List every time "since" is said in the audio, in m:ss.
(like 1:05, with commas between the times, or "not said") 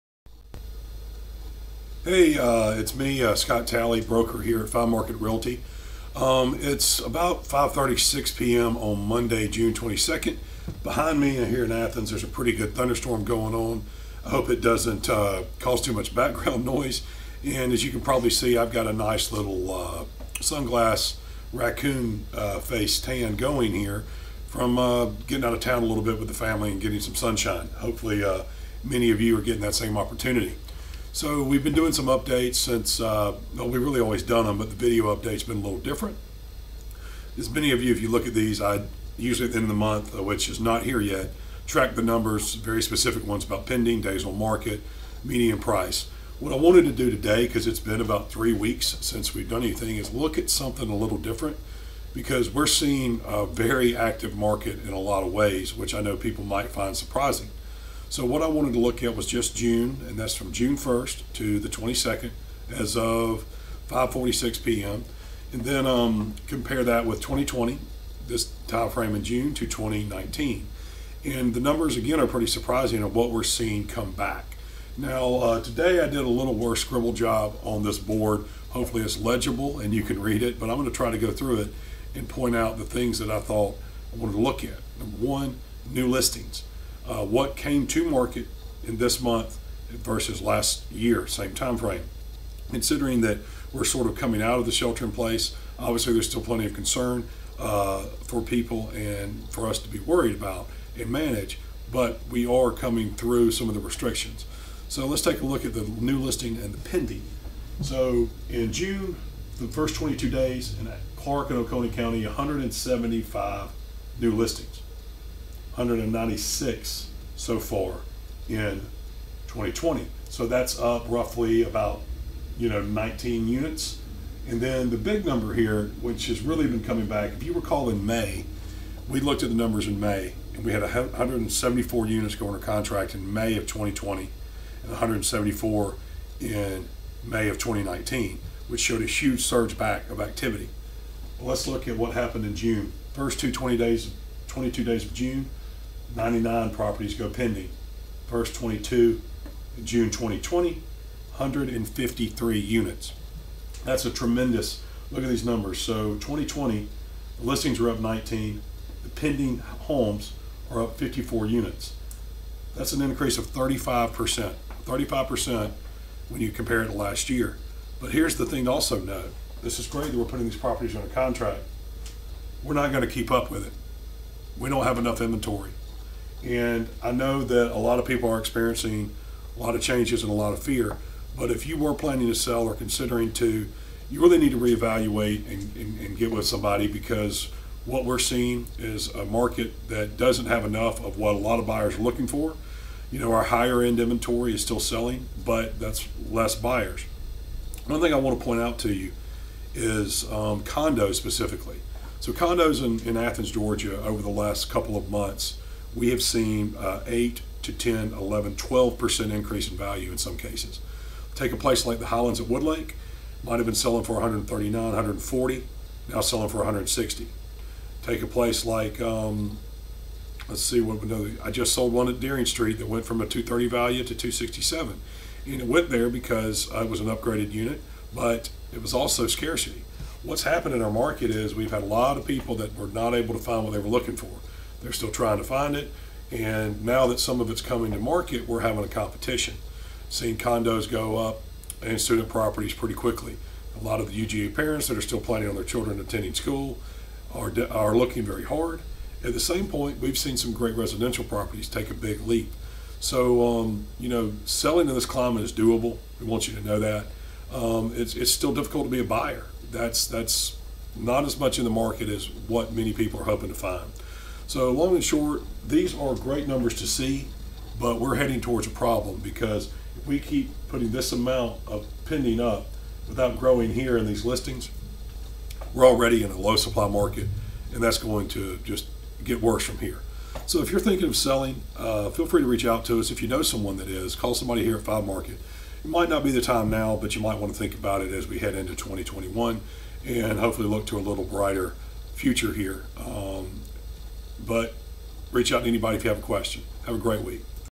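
0:32, 0:49.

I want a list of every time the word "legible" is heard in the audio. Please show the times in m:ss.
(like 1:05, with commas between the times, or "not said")
1:19.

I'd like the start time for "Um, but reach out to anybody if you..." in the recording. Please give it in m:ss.
4:52.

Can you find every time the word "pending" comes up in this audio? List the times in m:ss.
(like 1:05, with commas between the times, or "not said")
0:43, 1:46, 2:27, 2:39, 4:32.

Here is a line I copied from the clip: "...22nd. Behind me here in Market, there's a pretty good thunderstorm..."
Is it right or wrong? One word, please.
wrong.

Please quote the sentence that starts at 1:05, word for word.
And then um, compare that with 2020, this time frame in June to 2019.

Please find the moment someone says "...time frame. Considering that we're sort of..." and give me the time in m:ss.
1:31.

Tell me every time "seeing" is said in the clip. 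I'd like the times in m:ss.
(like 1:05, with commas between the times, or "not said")
0:52, 1:13, 3:08, 4:00.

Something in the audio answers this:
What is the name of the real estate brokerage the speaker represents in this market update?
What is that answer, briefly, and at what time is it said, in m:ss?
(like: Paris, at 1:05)
Five Market Realty, at 0:04.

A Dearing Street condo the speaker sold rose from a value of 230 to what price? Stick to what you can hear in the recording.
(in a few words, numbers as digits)
267.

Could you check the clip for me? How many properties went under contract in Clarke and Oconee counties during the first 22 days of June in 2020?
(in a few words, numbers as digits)
153.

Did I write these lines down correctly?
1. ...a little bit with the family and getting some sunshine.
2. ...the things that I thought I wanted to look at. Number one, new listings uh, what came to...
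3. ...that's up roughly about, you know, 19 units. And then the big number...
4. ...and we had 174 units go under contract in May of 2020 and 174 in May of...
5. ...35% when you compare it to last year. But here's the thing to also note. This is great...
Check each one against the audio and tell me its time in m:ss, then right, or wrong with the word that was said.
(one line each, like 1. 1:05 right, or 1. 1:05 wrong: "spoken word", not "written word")
1. 0:25 right
2. 1:22 right
3. 2:00 right
4. 2:10 right
5. 2:44 right.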